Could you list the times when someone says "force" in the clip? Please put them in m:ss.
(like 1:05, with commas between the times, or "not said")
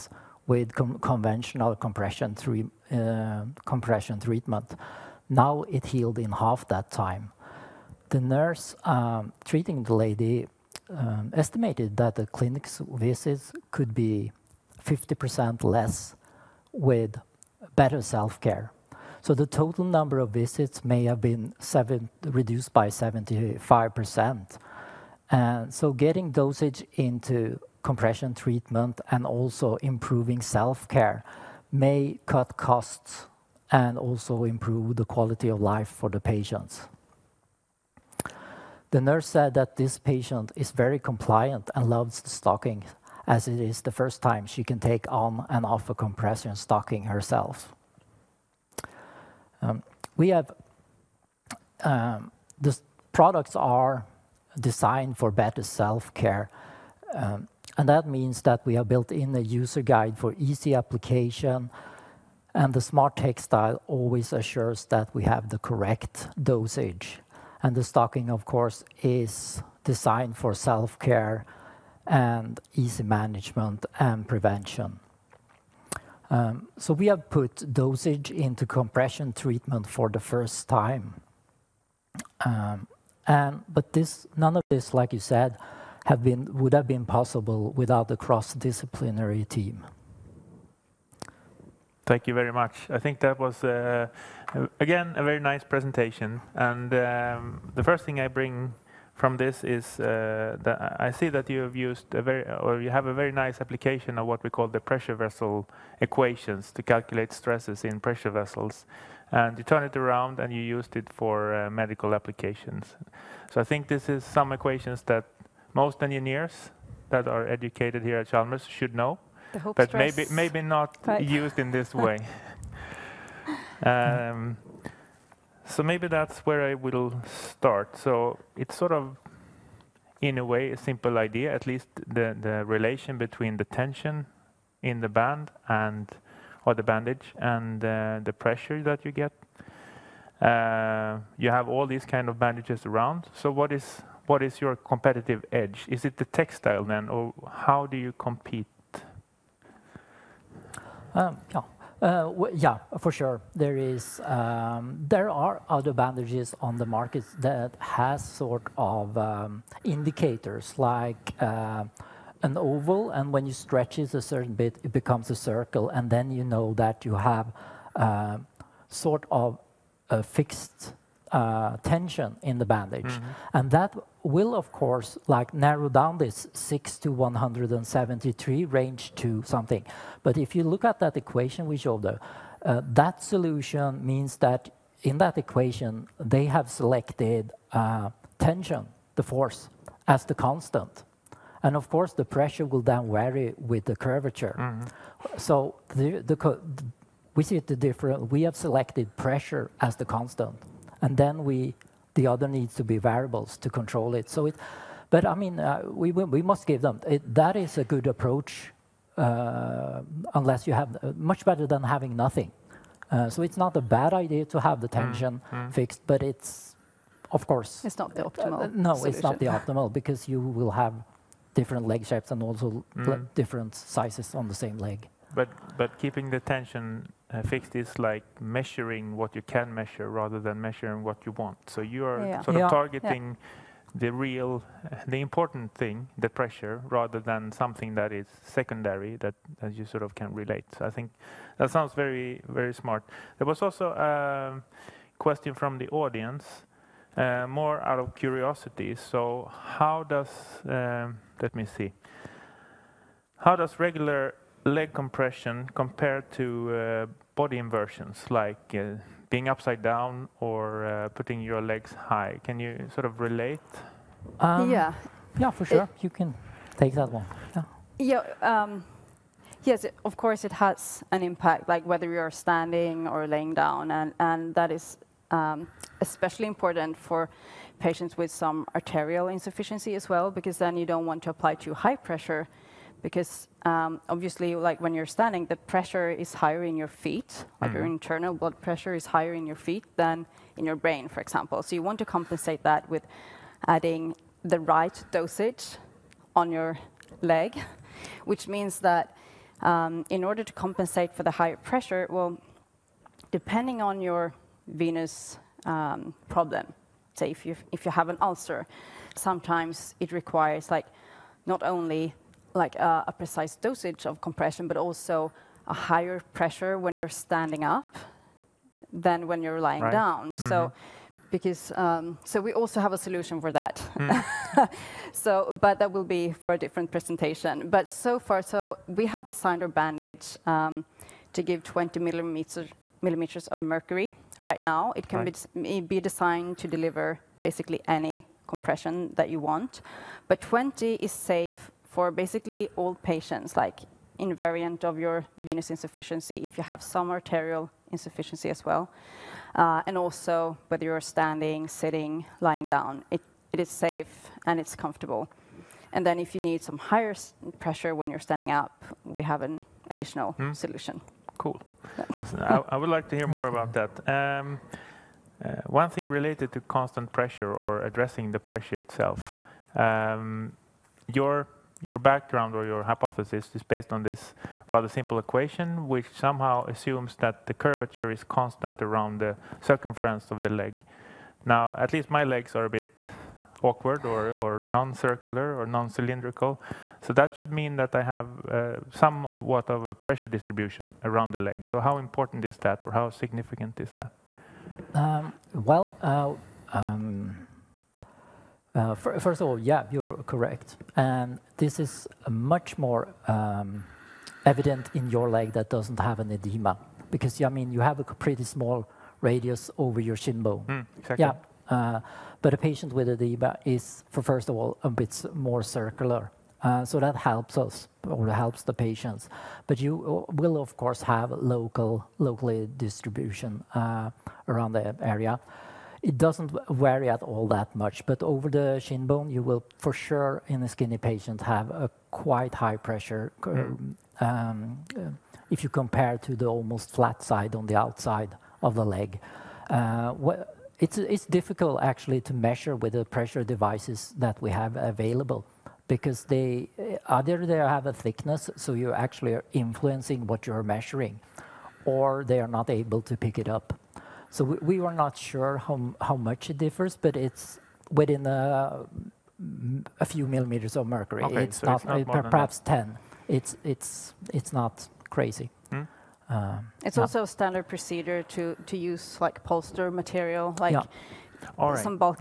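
3:09.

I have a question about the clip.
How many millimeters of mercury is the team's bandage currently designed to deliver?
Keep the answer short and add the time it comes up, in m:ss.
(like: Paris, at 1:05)
20, at 5:31.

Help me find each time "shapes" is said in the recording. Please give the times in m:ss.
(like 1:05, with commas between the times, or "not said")
3:42.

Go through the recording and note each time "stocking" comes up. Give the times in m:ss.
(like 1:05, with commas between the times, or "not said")
0:42, 0:46, 1:07.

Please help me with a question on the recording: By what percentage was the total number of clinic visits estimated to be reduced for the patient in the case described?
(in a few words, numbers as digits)
75%.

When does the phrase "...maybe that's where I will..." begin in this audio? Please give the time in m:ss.
2:05.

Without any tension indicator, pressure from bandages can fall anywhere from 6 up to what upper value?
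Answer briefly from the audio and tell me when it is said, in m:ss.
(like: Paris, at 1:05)
173, at 2:57.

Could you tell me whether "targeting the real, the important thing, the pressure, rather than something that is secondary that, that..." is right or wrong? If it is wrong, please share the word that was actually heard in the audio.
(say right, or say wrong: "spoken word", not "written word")
right.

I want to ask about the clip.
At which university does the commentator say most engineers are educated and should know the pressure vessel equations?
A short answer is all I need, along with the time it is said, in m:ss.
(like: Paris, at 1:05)
Chalmers, at 1:58.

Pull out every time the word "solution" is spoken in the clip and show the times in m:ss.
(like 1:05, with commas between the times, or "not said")
3:03, 3:38, 5:22, 6:00.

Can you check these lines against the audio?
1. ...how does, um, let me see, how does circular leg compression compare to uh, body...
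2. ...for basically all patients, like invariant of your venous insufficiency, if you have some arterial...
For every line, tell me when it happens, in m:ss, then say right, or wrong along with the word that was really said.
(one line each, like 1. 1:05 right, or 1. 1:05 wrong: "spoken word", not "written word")
1. 4:09 wrong: "regular", not "circular"
2. 5:41 right.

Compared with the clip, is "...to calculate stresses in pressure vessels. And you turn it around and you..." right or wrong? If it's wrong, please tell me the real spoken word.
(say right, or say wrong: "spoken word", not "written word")
right.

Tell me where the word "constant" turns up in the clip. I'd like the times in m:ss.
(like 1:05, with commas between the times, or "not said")
3:10, 3:20, 6:06, 6:18.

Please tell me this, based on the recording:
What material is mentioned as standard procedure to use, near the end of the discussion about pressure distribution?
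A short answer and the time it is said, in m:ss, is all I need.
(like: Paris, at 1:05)
Polyester, at 7:49.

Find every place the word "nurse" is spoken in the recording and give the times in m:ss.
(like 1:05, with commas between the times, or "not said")
0:08, 0:39.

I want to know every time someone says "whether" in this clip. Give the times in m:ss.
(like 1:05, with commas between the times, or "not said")
4:31, 5:50.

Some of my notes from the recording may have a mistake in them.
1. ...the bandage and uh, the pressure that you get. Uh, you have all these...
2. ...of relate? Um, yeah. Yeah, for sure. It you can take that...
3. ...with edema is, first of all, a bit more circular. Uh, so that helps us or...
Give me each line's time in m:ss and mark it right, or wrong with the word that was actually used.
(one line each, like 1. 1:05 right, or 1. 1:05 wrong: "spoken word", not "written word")
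1. 2:16 right
2. 4:23 right
3. 6:52 right.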